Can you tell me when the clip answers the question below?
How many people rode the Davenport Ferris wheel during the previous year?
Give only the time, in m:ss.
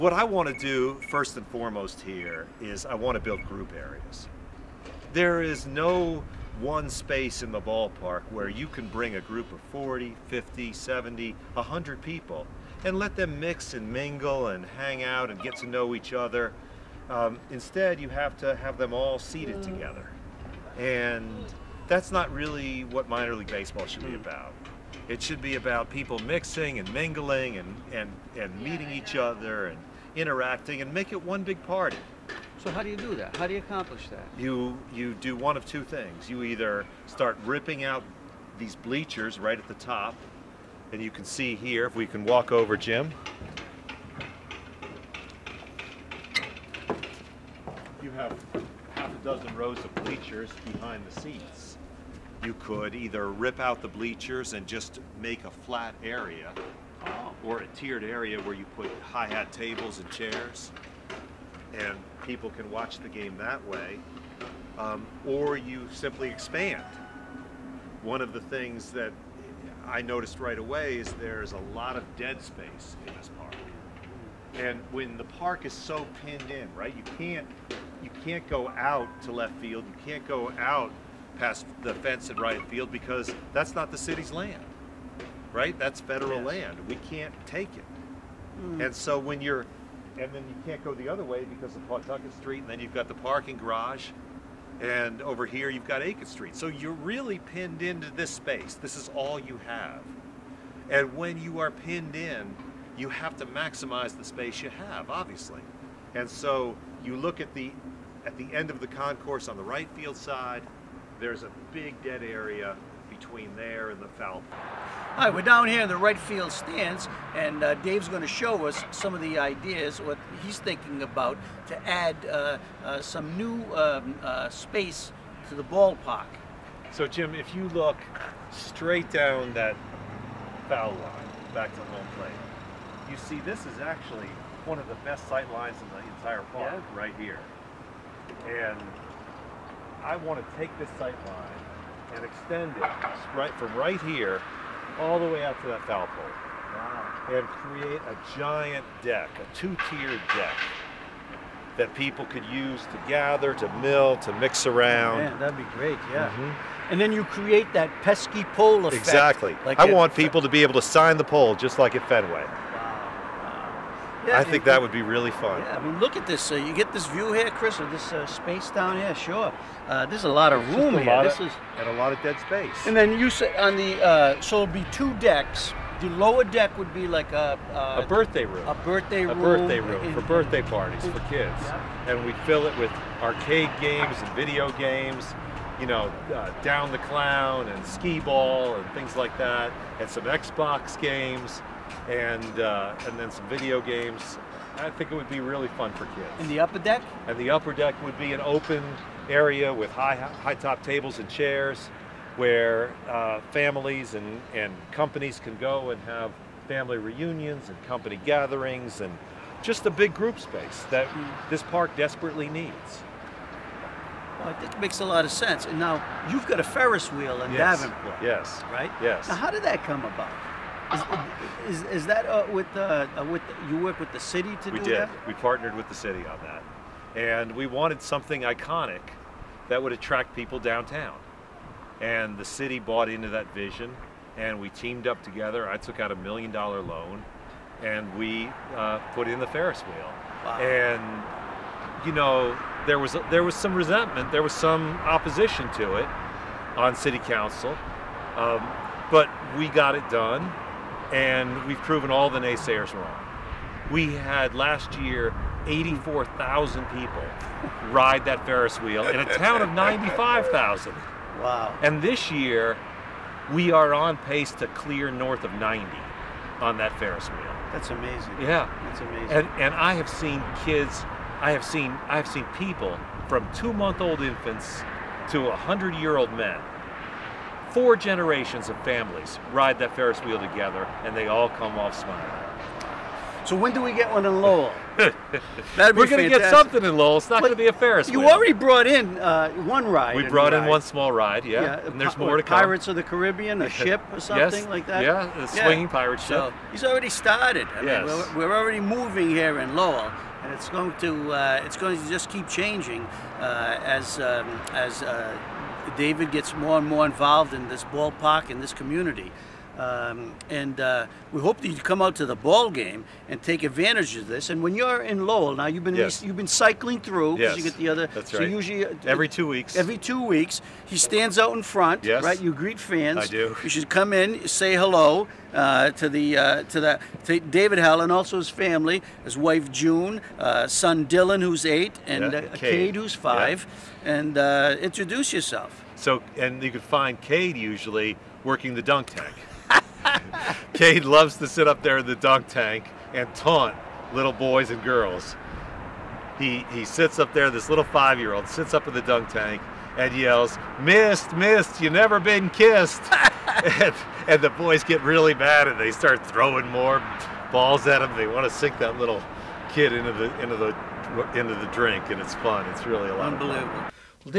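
4:15.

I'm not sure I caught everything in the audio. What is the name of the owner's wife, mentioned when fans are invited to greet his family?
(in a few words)
June.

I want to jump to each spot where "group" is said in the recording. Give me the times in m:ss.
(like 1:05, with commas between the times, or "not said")
0:03, 0:09, 3:30.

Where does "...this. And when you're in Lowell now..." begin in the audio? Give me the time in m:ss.
5:14.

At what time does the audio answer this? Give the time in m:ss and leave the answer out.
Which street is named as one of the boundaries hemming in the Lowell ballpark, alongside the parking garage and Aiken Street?
1:31.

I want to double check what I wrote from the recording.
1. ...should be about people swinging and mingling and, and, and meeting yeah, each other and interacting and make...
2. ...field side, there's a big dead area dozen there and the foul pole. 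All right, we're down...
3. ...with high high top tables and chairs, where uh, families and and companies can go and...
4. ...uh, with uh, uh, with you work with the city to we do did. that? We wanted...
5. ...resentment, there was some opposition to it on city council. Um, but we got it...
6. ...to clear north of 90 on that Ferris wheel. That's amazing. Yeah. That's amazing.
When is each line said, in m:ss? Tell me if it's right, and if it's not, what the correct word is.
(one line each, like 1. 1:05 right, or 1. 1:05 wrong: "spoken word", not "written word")
1. 0:25 wrong: "mixing", not "swinging"
2. 1:49 wrong: "between", not "dozen"
3. 3:19 right
4. 3:42 wrong: "partnered", not "wanted"
5. 4:03 right
6. 4:24 right.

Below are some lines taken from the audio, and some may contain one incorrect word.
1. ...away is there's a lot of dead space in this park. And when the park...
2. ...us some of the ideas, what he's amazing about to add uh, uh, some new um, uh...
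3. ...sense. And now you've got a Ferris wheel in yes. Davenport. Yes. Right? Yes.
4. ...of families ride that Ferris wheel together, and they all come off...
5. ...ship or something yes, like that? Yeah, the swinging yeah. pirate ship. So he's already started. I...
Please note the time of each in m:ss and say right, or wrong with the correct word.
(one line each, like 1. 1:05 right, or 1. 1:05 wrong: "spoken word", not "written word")
1. 1:10 right
2. 1:58 wrong: "thinking", not "amazing"
3. 3:35 right
4. 4:38 right
5. 4:53 right.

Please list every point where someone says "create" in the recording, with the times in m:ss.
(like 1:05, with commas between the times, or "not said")
2:27, 2:37.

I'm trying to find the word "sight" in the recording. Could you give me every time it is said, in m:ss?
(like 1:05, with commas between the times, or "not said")
2:15, 2:20.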